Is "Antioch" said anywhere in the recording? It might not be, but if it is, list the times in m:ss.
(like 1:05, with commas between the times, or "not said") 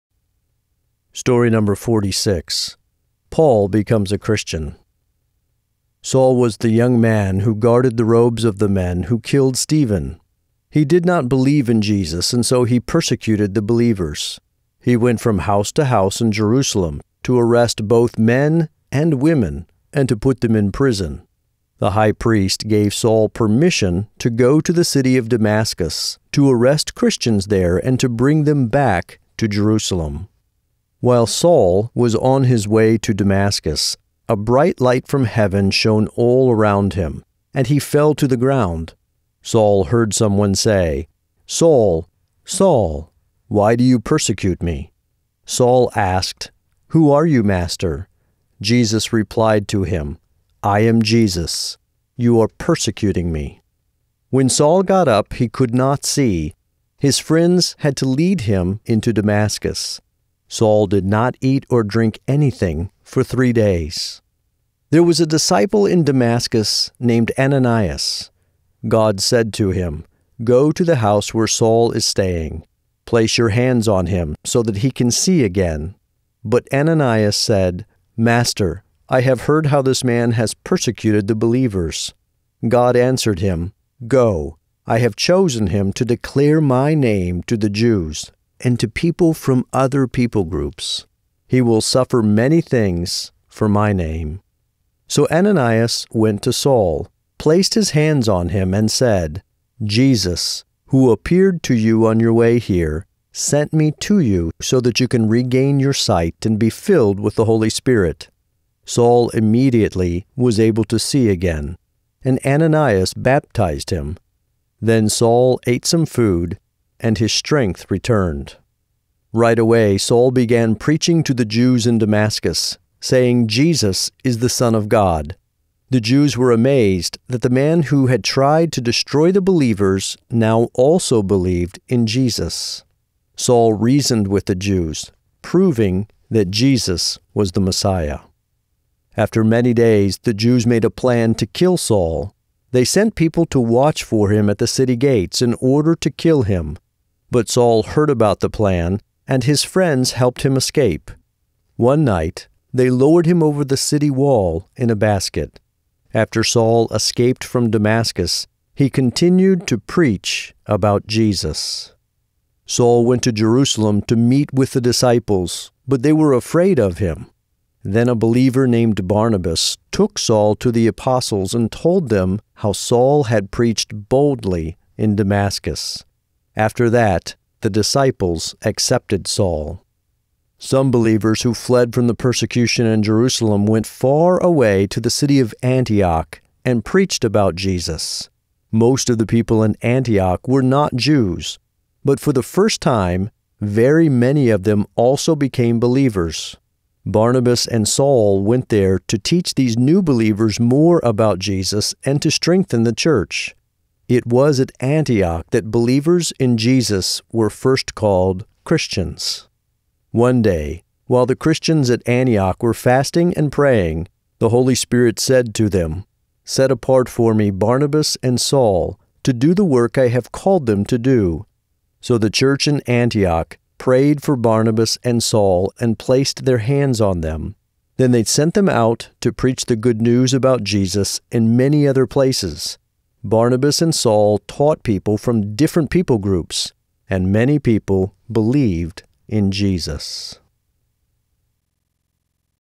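3:05, 3:09, 3:24, 3:32, 3:42.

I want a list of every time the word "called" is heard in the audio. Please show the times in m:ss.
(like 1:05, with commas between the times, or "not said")
3:27, 3:40.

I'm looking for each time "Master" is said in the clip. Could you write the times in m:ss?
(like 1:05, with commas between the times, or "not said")
0:47, 1:18.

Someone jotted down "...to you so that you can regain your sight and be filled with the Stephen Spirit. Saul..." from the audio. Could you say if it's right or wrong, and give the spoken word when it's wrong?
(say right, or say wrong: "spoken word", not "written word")
wrong: "Holy", not "Stephen".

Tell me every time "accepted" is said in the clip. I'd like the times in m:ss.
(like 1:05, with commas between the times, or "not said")
2:58.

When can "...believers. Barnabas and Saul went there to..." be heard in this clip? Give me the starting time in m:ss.
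3:15.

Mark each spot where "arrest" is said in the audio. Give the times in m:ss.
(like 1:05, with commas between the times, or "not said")
0:17, 0:26.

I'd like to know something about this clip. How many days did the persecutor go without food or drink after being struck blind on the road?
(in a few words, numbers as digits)
3.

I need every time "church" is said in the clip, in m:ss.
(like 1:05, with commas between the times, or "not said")
3:22, 3:42.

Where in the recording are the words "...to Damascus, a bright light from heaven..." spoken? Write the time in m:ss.
0:32.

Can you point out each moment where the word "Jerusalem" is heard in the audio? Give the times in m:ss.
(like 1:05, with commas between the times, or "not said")
0:16, 0:29, 2:43, 3:03.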